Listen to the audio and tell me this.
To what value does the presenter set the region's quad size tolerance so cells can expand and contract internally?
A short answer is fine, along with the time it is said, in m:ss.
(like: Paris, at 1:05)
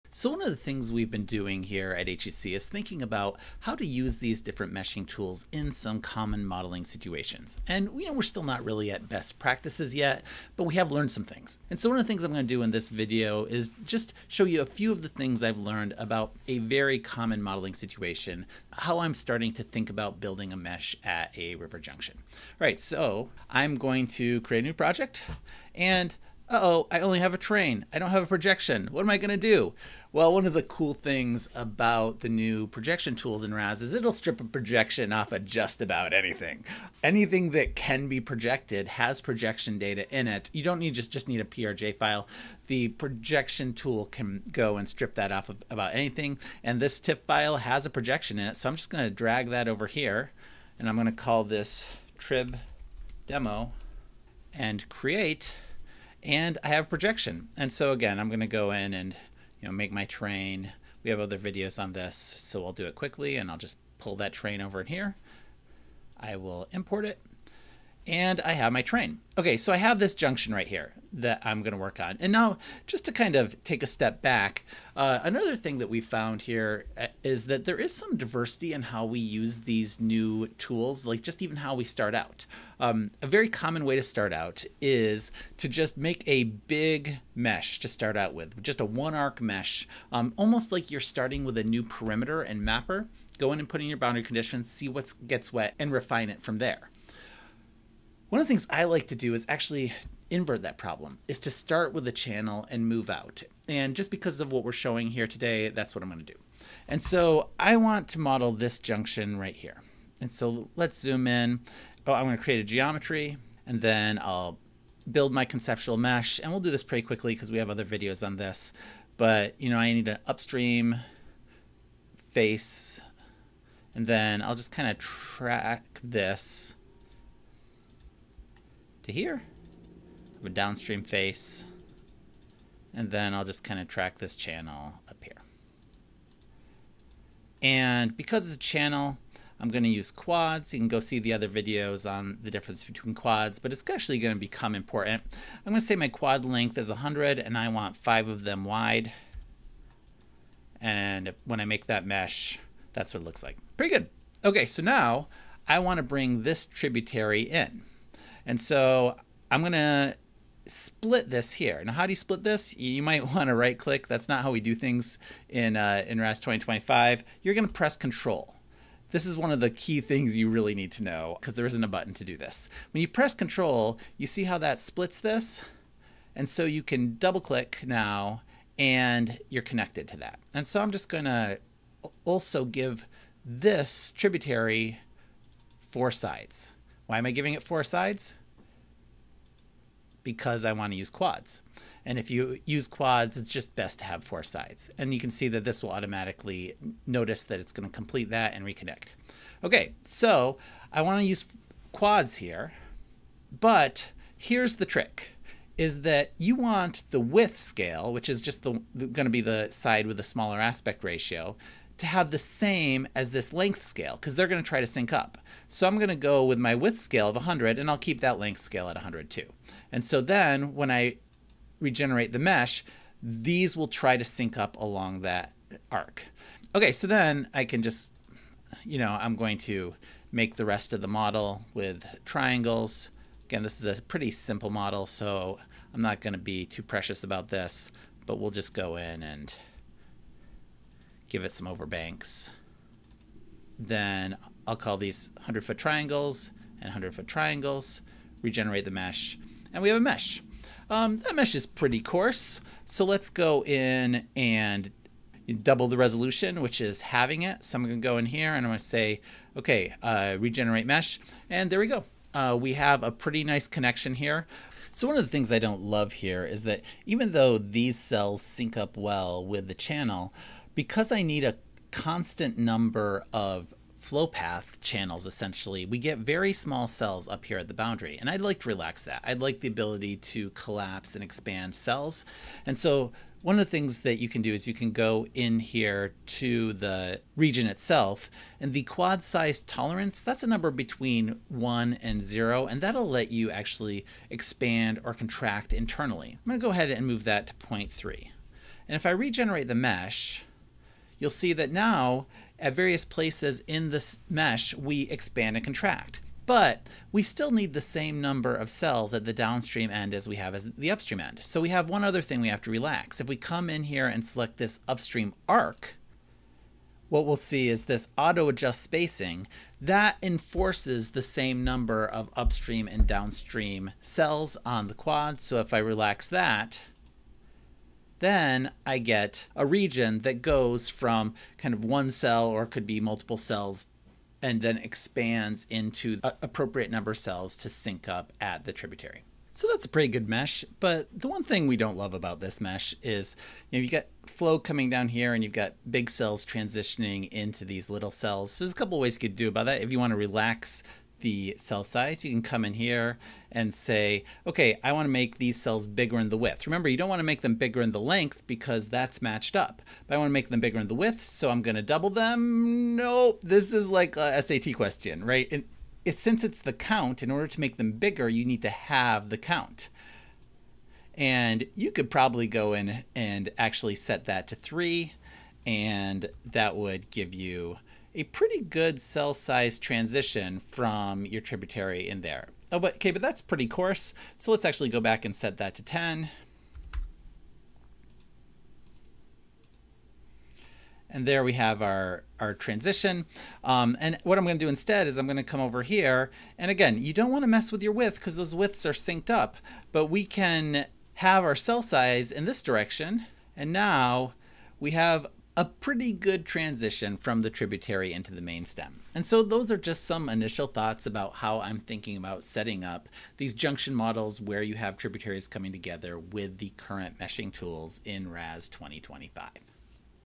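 0.3, at 4:57.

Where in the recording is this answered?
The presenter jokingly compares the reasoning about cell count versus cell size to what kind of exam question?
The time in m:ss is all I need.
6:04.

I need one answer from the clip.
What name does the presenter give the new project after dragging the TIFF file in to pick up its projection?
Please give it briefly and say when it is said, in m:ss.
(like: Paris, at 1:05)
trib demo, at 0:52.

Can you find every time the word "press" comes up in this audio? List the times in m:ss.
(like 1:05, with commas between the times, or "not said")
2:47, 2:53.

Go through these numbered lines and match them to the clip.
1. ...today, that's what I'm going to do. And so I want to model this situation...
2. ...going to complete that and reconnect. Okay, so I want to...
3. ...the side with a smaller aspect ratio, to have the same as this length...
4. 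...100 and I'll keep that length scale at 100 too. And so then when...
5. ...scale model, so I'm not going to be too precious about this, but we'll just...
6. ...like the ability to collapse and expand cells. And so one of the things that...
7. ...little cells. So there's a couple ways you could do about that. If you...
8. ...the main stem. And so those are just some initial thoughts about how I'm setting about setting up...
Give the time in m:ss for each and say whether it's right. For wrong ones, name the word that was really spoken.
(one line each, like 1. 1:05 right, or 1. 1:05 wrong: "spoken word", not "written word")
1. 1:45 wrong: "junction", not "situation"
2. 3:17 right
3. 3:29 right
4. 3:37 right
5. 3:54 wrong: "simple", not "scale"
6. 4:39 right
7. 5:47 right
8. 6:48 wrong: "thinking", not "setting".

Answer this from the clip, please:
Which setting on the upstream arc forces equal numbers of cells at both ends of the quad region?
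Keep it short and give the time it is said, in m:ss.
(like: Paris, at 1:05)
auto adjust spacing, at 5:18.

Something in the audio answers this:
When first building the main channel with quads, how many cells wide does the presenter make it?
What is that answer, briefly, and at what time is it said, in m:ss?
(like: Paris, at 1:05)
5, at 2:27.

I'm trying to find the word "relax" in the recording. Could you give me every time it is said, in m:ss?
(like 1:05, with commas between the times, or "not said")
4:38, 5:12, 5:25, 5:50.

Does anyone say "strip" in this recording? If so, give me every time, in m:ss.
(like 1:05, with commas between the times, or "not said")
0:34, 0:44.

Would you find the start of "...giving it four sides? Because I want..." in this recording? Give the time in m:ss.
3:07.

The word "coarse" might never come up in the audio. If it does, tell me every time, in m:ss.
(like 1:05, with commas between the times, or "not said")
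4:12, 6:23.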